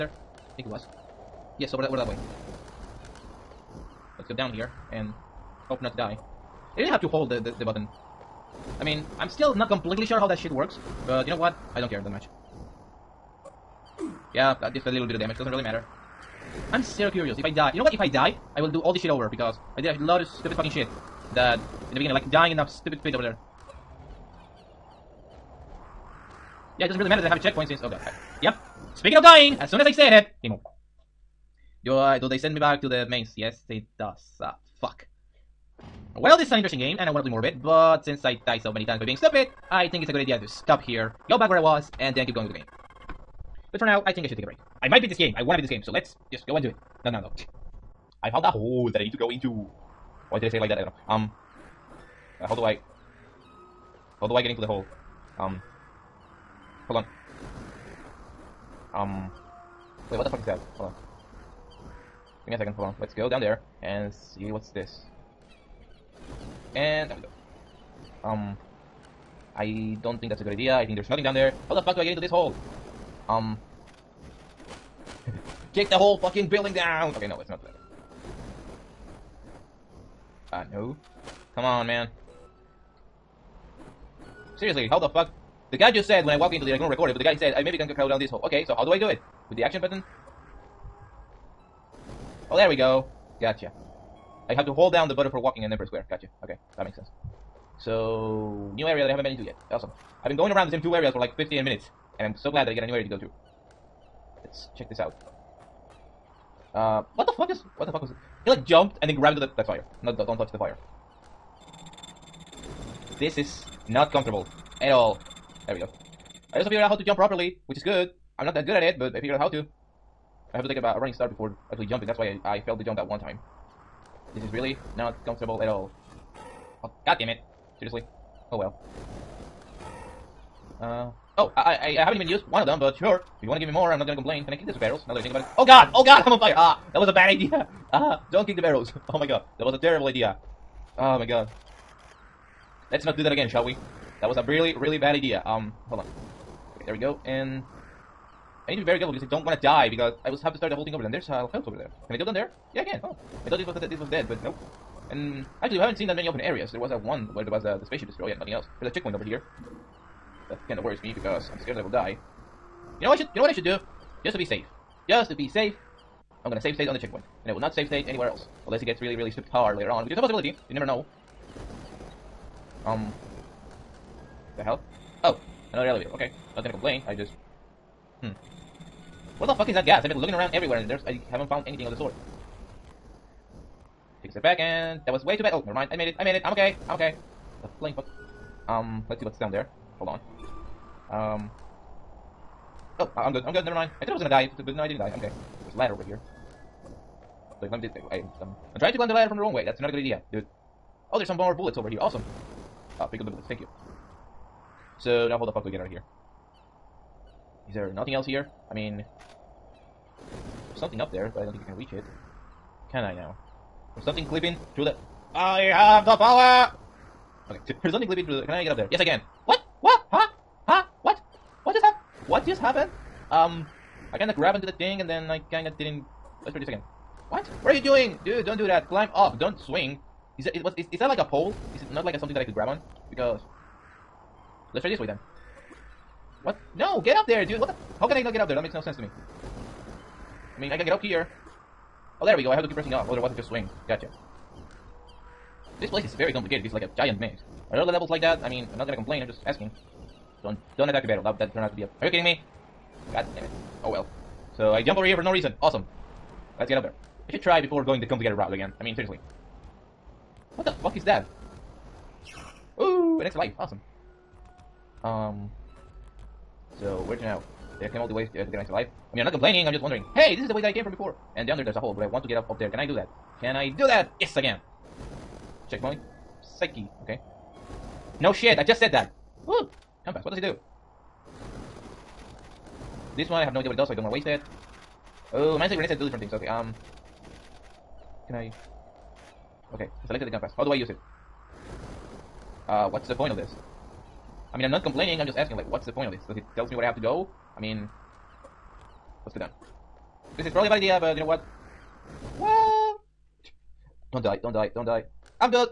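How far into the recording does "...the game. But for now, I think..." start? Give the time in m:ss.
0:42.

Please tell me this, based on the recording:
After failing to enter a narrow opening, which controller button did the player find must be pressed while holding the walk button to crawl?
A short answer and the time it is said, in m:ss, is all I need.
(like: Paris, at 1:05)
Square, at 1:35.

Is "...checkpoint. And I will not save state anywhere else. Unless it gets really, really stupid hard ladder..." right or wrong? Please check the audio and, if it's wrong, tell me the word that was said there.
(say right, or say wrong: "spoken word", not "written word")
wrong: "later", not "ladder".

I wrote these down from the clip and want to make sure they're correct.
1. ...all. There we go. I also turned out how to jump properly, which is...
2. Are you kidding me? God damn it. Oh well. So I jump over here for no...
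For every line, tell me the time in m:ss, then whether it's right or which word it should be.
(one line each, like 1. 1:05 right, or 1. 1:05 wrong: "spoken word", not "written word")
1. 1:54 wrong: "figured", not "turned"
2. 4:12 right.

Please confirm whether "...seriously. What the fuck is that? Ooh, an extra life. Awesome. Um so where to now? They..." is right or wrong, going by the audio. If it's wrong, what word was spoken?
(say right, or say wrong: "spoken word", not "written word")
right.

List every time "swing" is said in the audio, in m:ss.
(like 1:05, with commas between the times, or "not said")
3:49, 4:03.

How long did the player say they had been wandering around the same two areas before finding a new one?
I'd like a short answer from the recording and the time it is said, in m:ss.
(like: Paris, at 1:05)
15 minutes, at 1:41.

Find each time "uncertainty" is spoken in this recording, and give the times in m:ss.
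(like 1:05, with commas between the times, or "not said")
not said.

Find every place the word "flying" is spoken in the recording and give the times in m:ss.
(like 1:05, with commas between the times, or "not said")
3:07.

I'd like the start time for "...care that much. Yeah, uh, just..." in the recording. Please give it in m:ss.
0:11.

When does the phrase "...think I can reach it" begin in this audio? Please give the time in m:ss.
3:31.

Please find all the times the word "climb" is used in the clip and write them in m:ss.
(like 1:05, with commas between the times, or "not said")
3:18, 3:48.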